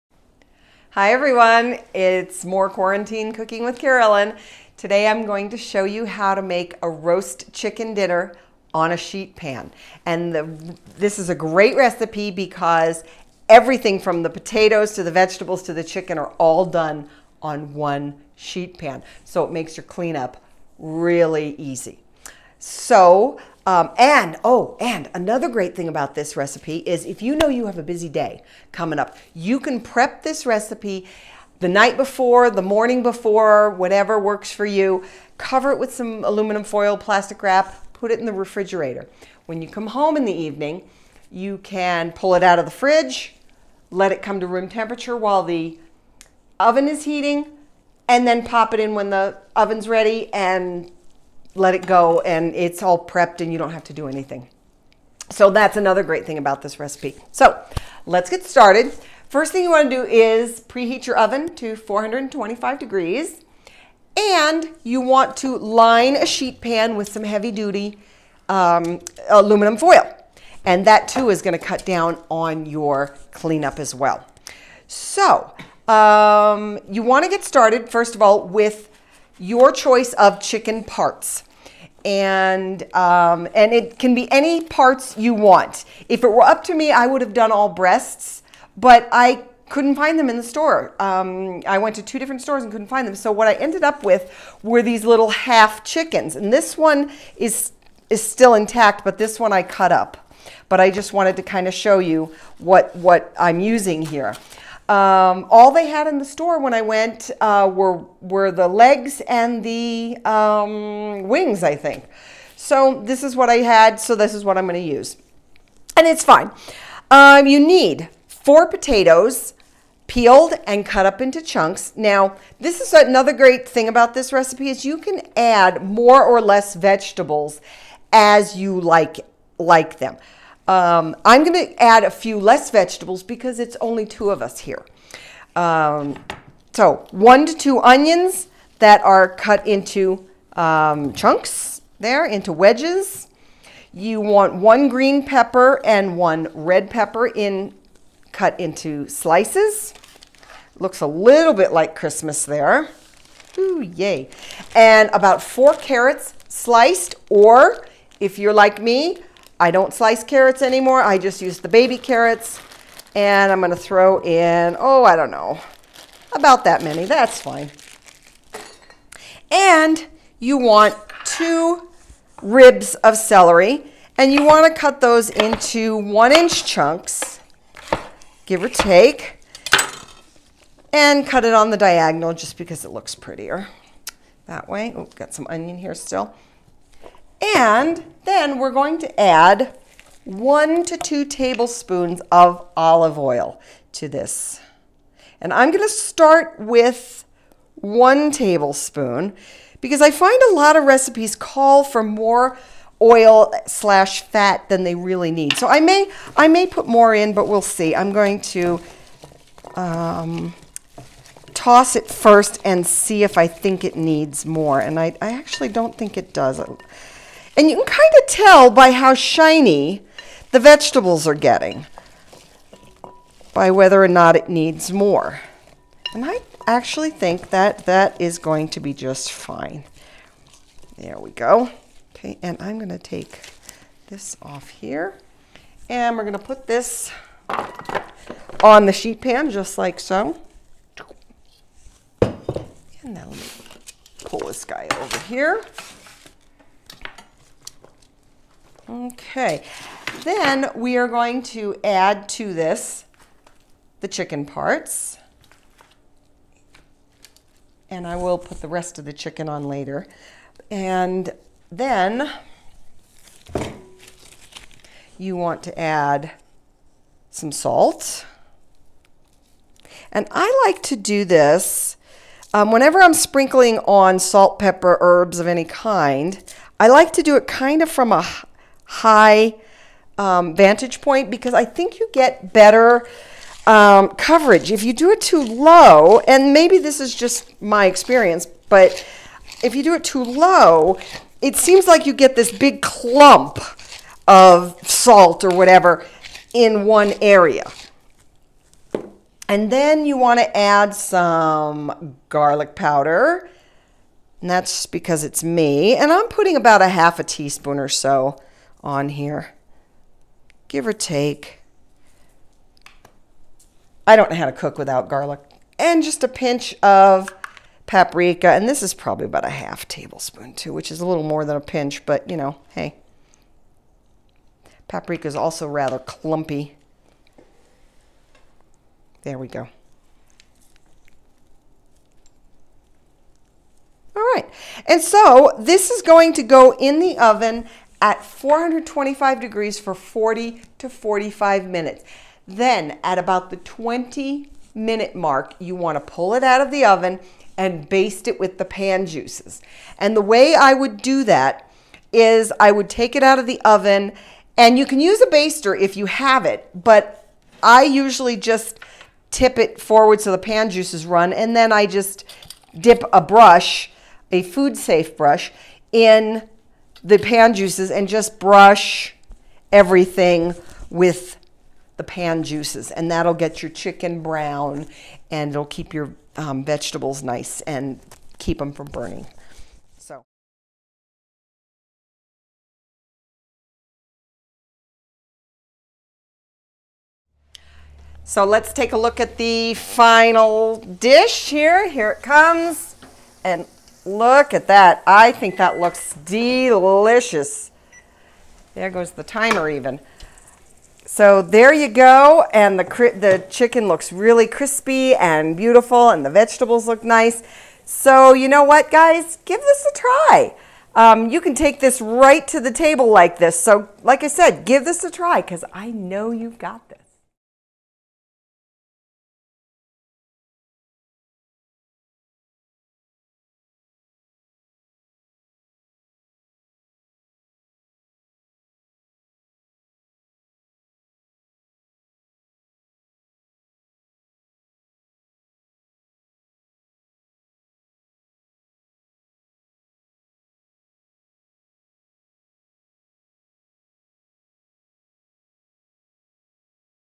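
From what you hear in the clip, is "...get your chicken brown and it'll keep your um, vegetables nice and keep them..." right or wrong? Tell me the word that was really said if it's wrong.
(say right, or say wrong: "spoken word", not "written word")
right.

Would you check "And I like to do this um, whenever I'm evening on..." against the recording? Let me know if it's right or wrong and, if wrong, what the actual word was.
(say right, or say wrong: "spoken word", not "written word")
wrong: "sprinkling", not "evening".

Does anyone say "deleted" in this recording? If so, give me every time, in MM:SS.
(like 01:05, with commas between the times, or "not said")
not said.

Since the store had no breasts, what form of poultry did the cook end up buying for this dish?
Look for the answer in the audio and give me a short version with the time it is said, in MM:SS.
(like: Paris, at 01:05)
half chickens, at 01:35.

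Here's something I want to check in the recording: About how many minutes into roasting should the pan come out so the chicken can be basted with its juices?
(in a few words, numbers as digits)
20 minutes.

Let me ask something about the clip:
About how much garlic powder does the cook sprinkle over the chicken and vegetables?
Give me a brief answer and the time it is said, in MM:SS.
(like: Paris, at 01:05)
half a teaspoon, at 05:06.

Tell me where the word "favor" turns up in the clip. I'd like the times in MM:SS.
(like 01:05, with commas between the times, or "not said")
not said.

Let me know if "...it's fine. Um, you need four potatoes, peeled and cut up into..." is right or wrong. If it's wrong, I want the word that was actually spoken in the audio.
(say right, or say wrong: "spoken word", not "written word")
right.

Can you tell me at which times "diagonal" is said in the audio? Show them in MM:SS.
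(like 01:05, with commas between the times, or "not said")
03:01.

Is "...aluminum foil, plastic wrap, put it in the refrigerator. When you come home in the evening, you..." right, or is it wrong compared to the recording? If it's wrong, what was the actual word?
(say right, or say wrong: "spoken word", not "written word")
right.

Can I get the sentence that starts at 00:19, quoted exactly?
So it makes your cleanup really easy.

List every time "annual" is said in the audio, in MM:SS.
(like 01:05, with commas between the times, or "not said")
not said.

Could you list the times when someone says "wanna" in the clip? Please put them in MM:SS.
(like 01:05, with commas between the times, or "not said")
00:59, 01:17.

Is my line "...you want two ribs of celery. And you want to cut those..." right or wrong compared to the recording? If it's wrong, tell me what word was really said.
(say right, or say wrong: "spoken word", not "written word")
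right.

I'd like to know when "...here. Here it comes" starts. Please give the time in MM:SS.
06:31.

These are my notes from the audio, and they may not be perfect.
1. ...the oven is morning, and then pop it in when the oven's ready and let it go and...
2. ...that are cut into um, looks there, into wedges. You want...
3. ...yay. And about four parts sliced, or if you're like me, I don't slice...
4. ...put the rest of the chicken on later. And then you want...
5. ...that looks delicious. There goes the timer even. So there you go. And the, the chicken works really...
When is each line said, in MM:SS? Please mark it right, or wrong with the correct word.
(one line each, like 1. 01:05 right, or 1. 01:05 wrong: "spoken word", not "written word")
1. 00:45 wrong: "heating", not "morning"
2. 02:18 wrong: "chunks", not "looks"
3. 02:33 wrong: "carrots", not "parts"
4. 04:18 right
5. 06:35 wrong: "looks", not "works".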